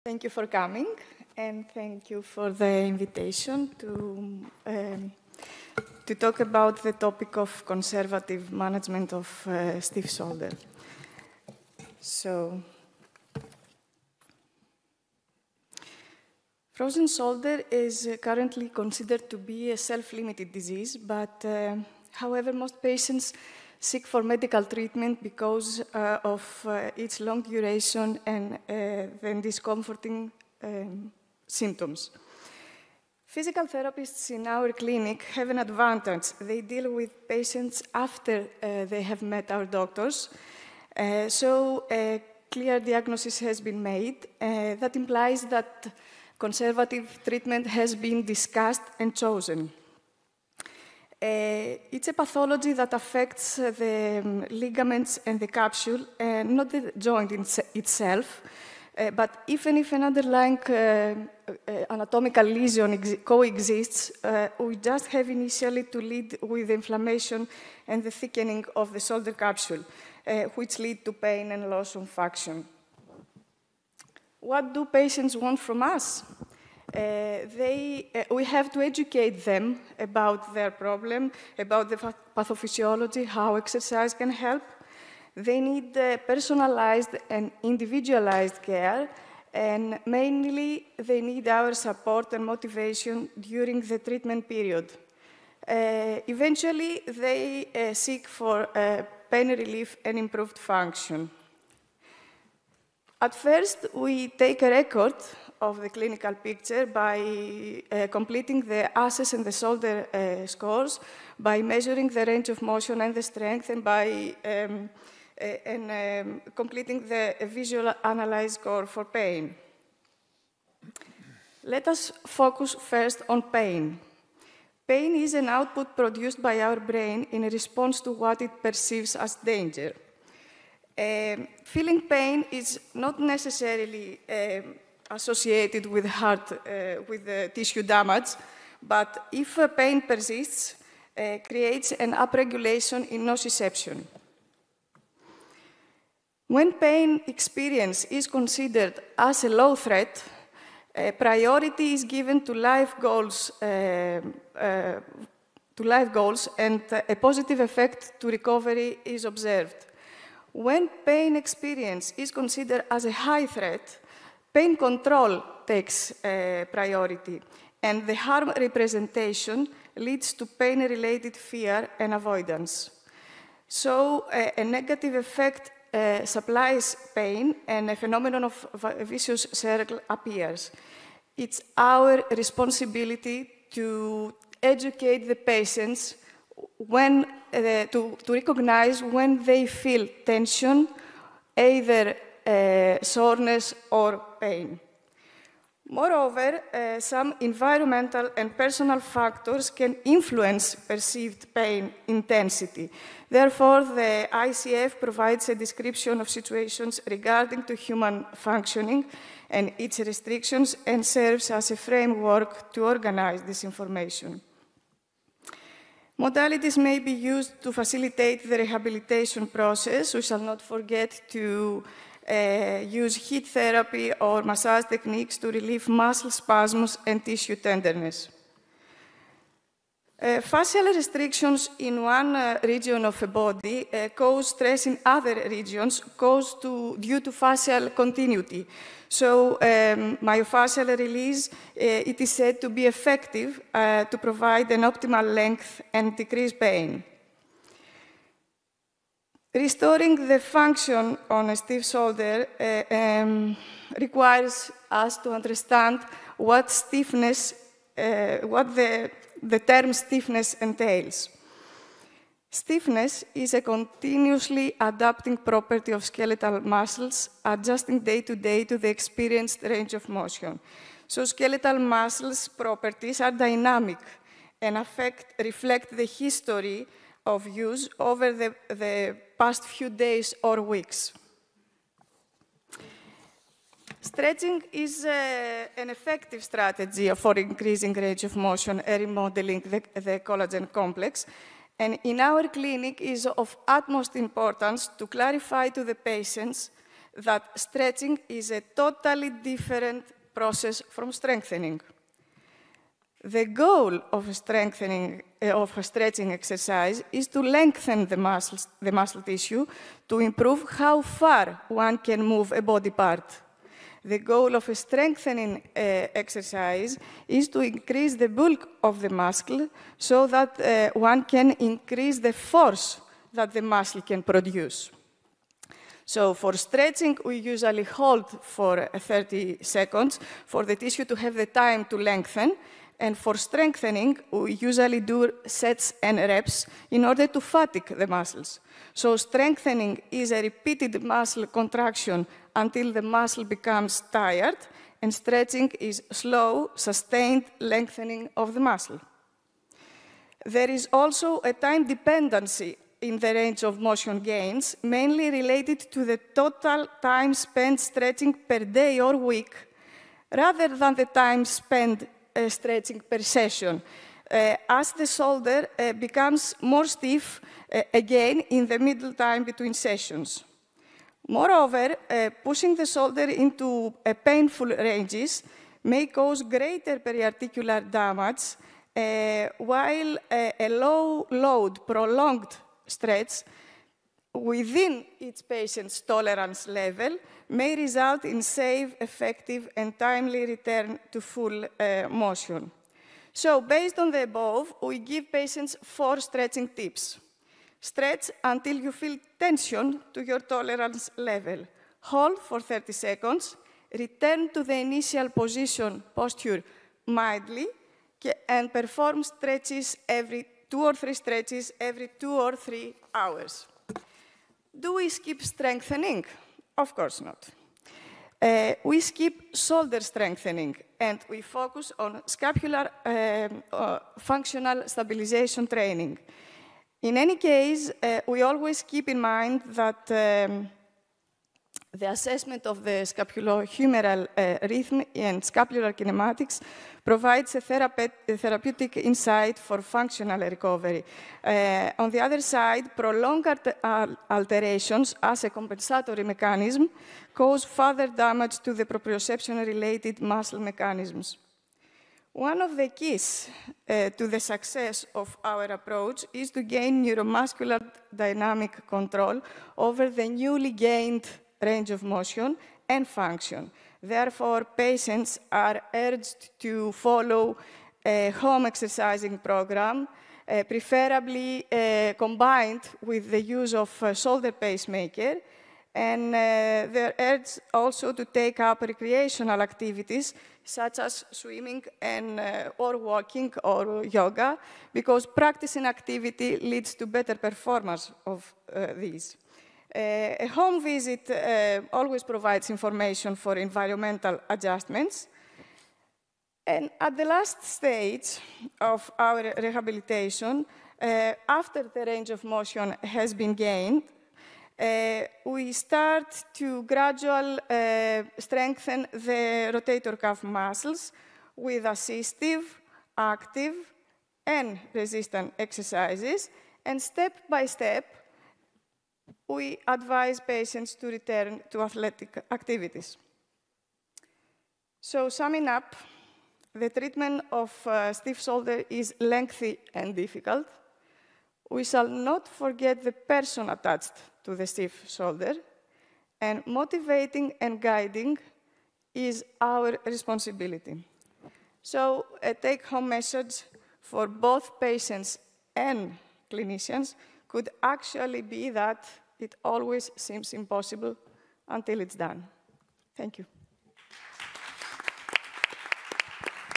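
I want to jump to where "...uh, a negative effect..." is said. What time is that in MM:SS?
02:54.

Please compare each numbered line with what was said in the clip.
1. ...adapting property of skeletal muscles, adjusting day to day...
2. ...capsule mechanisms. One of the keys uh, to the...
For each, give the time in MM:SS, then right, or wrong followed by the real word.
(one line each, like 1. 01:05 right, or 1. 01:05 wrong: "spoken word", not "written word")
1. 04:24 right
2. 07:30 wrong: "muscle", not "capsule".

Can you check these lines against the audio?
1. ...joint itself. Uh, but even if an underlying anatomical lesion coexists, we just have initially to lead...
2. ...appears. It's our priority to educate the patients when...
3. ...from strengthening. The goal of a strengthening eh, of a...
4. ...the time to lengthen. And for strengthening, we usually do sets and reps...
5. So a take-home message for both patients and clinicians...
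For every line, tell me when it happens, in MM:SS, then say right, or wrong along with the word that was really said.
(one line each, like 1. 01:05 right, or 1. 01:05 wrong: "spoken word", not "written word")
1. 00:56 right
2. 03:00 wrong: "responsibility", not "priority"
3. 05:00 right
4. 05:31 right
5. 09:01 right.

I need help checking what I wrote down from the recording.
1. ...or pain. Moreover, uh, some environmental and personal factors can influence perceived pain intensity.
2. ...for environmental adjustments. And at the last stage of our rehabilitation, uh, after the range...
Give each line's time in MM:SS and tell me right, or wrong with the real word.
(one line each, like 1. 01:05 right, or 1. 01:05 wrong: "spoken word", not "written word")
1. 03:13 right
2. 08:13 right.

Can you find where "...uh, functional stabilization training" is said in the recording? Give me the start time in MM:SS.
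07:03.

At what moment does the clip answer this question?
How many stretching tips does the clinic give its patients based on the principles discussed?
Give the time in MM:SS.
06:35.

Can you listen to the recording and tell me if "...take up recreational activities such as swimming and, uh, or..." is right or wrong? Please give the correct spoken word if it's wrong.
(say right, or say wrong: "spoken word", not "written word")
right.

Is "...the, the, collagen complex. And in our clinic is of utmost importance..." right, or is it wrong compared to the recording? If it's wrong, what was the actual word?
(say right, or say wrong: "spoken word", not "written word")
right.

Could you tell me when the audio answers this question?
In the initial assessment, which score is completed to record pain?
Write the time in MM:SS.
01:57.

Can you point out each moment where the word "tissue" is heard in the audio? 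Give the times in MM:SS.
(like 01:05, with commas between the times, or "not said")
02:17, 03:47, 05:09, 05:30.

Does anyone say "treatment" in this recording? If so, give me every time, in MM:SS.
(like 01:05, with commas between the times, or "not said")
00:24, 00:47, 01:33, 08:46.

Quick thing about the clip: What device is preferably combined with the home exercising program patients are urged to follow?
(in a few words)
shoulder pacemaker.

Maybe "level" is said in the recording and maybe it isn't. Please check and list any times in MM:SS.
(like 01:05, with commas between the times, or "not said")
06:26, 06:41.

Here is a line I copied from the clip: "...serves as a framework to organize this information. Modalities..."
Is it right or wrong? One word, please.
right.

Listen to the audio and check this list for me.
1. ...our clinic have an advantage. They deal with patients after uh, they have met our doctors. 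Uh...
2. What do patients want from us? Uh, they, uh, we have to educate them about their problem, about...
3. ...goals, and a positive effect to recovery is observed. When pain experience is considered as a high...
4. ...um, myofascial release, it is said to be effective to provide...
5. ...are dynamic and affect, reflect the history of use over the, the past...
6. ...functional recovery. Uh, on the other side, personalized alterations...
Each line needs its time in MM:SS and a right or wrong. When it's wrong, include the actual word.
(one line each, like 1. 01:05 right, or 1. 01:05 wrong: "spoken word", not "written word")
1. 00:34 right
2. 01:14 right
3. 02:36 right
4. 03:59 right
5. 04:33 right
6. 07:19 wrong: "prolonged", not "personalized".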